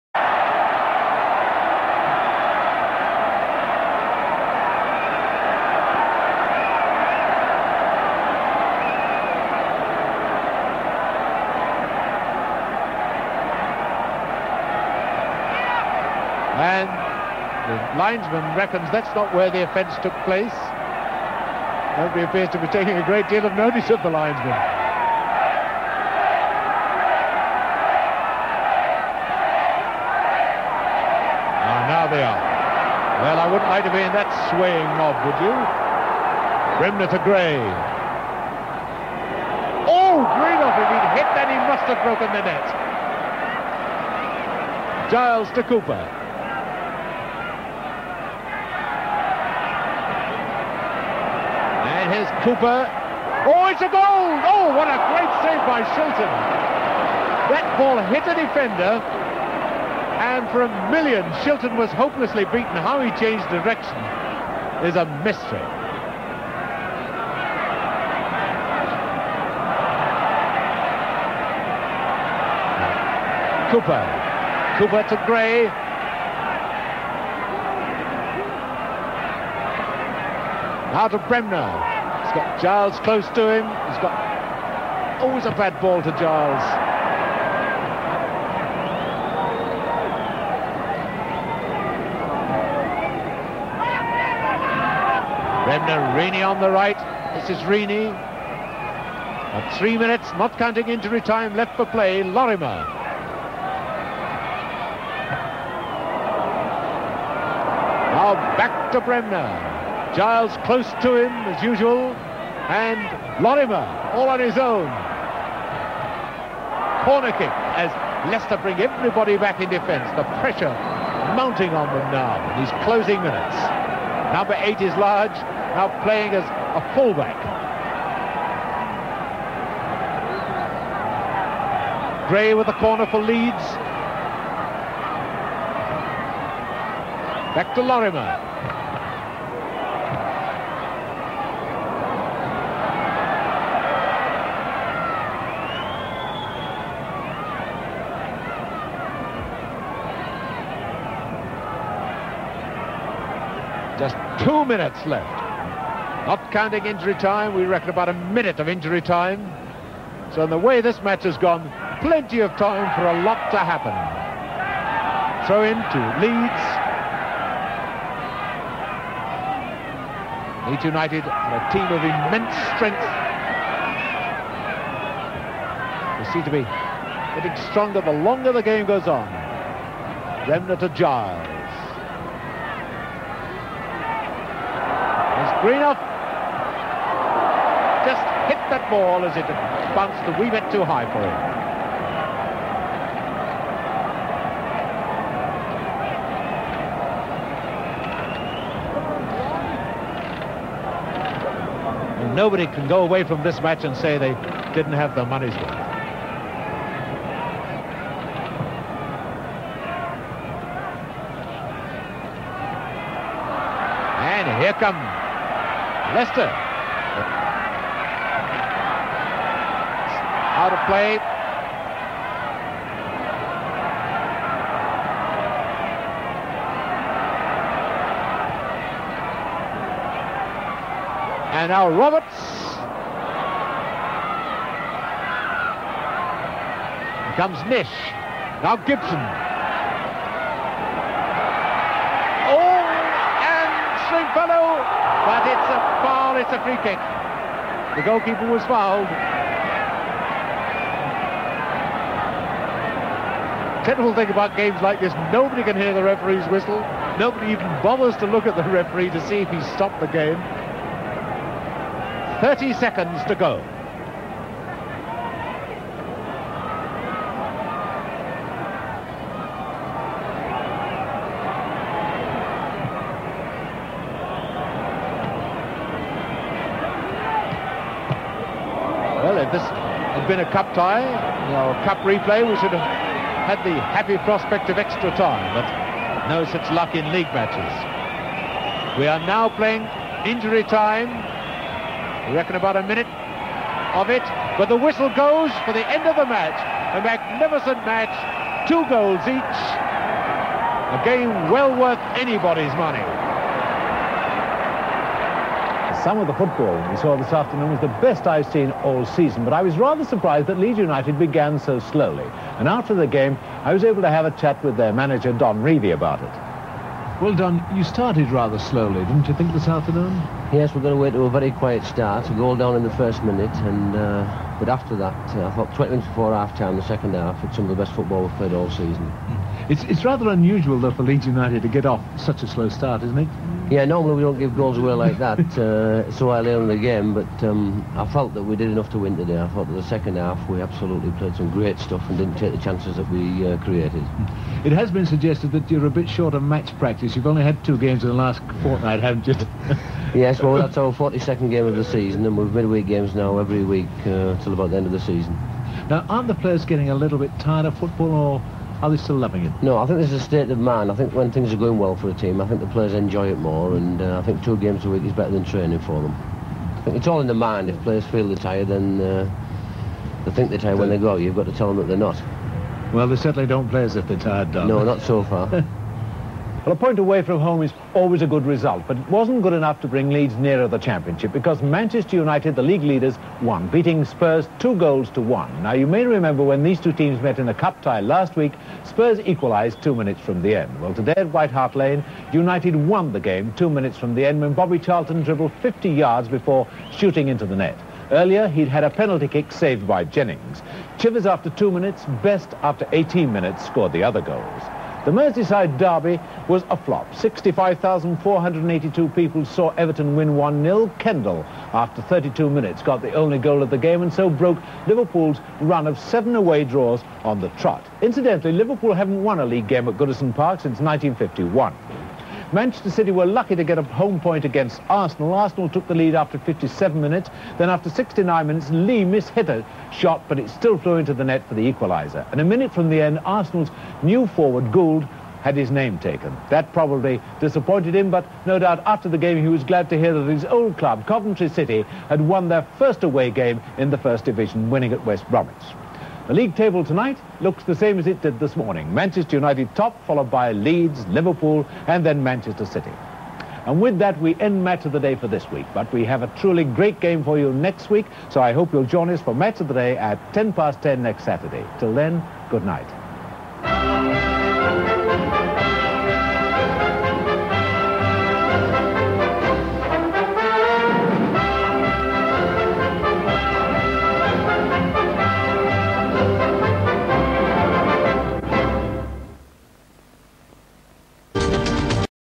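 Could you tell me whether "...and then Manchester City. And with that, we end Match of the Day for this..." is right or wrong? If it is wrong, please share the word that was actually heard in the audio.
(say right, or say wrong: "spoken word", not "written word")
right.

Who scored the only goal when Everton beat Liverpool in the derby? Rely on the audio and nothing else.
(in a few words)
Kendall.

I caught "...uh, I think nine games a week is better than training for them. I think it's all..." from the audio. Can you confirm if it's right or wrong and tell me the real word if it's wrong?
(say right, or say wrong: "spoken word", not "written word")
wrong: "two", not "nine".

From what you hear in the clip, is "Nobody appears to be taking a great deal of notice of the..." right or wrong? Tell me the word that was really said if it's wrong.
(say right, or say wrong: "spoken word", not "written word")
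right.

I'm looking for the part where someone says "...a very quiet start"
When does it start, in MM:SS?
05:21.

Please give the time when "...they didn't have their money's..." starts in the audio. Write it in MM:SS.
03:24.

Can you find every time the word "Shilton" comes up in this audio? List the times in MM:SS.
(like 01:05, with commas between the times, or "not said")
00:55, 01:01.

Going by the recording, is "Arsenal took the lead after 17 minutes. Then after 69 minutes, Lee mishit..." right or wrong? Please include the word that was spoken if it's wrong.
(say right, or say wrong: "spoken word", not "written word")
wrong: "57", not "17".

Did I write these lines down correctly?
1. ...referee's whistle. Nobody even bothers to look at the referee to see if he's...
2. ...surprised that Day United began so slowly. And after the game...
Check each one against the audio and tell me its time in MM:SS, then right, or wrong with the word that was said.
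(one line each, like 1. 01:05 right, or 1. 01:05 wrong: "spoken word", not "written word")
1. 04:16 right
2. 05:10 wrong: "Leeds", not "Day".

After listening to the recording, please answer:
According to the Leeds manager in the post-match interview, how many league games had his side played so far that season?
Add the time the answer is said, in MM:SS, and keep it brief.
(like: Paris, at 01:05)
42, at 05:50.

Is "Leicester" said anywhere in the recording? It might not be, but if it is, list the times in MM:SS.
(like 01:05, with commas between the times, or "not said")
01:58, 03:36.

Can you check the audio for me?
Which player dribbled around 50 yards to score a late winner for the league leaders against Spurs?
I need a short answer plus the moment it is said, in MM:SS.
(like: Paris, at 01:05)
Bobby Charlton, at 06:34.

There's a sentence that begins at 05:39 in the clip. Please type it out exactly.
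I thought that the second half we absolutely played some great stuff and didn't take the chances that we uh, created.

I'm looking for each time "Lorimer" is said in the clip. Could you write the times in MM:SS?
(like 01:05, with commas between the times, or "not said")
01:42, 01:53, 02:17.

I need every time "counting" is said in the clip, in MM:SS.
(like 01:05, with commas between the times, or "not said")
01:40, 02:36.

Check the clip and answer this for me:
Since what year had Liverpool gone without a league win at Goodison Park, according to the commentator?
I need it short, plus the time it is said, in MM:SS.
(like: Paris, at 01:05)
1951, at 07:00.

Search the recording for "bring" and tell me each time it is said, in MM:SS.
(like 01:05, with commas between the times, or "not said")
01:58, 06:19.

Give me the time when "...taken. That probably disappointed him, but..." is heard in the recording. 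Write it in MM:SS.
07:15.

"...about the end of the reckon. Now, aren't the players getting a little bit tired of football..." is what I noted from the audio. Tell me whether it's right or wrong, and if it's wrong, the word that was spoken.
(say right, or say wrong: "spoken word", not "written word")
wrong: "season", not "reckon".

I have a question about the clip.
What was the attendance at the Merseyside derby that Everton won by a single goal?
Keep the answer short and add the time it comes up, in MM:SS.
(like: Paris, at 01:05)
65,482, at 06:47.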